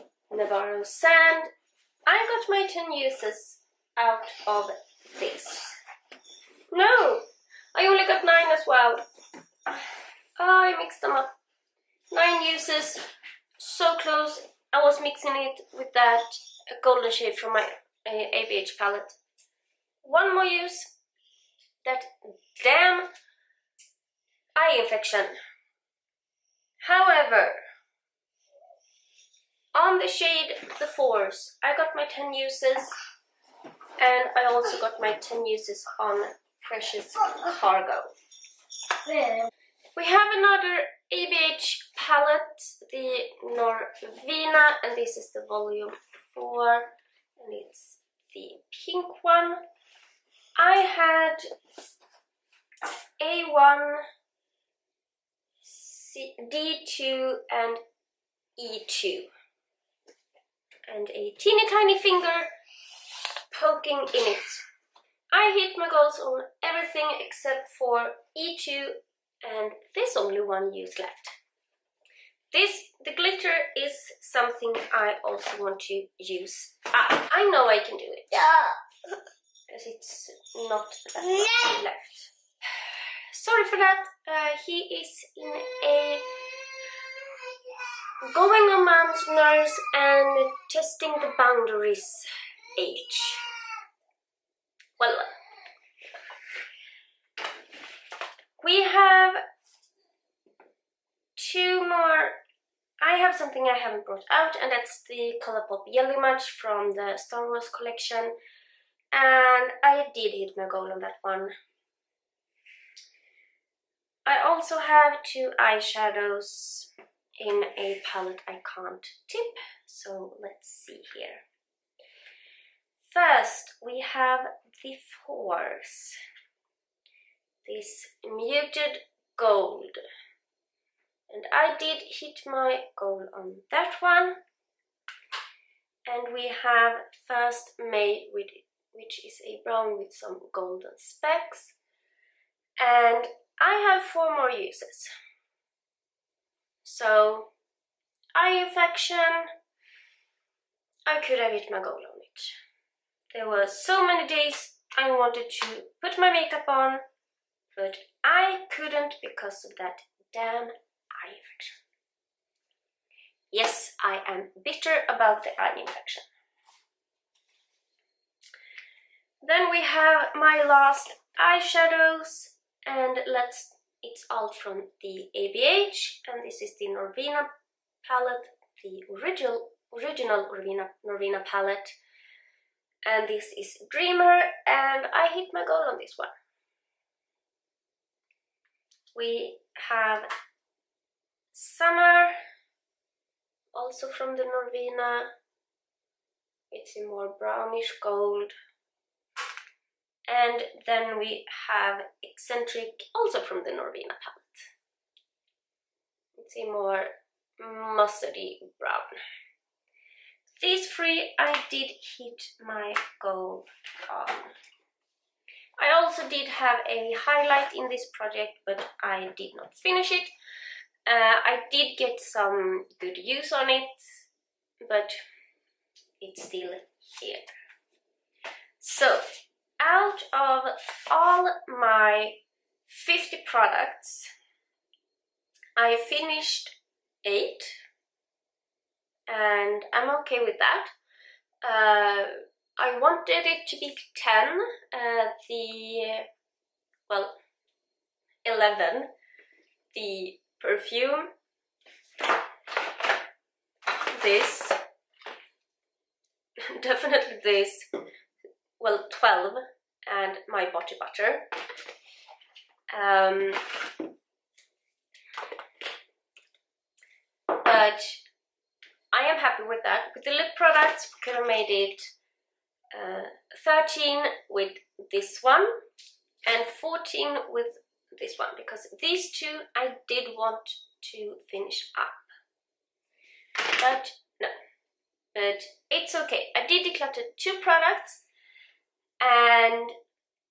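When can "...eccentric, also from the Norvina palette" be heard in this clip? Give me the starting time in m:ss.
3:22.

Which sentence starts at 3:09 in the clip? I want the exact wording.
We have Summer, also from the Norvina.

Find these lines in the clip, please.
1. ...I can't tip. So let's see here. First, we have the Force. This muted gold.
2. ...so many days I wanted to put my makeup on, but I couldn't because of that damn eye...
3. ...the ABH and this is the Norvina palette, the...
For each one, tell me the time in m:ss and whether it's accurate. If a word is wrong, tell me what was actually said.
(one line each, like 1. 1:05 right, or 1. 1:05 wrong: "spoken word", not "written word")
1. 1:58 right
2. 2:33 right
3. 2:55 right.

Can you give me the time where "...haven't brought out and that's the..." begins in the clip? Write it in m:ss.
1:43.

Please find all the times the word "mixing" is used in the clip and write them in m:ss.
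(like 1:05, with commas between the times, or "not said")
0:15.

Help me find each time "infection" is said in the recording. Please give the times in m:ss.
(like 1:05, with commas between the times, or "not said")
0:24, 2:28, 2:41, 2:45.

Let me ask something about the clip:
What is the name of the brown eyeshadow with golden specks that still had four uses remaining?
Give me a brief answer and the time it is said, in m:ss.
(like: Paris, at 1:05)
First May, at 2:17.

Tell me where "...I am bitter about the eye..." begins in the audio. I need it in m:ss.
2:44.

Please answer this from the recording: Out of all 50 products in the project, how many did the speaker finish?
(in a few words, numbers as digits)
8.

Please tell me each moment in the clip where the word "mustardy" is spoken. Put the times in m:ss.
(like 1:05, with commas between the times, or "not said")
3:27.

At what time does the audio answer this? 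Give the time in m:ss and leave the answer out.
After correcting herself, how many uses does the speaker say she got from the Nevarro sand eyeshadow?
0:12.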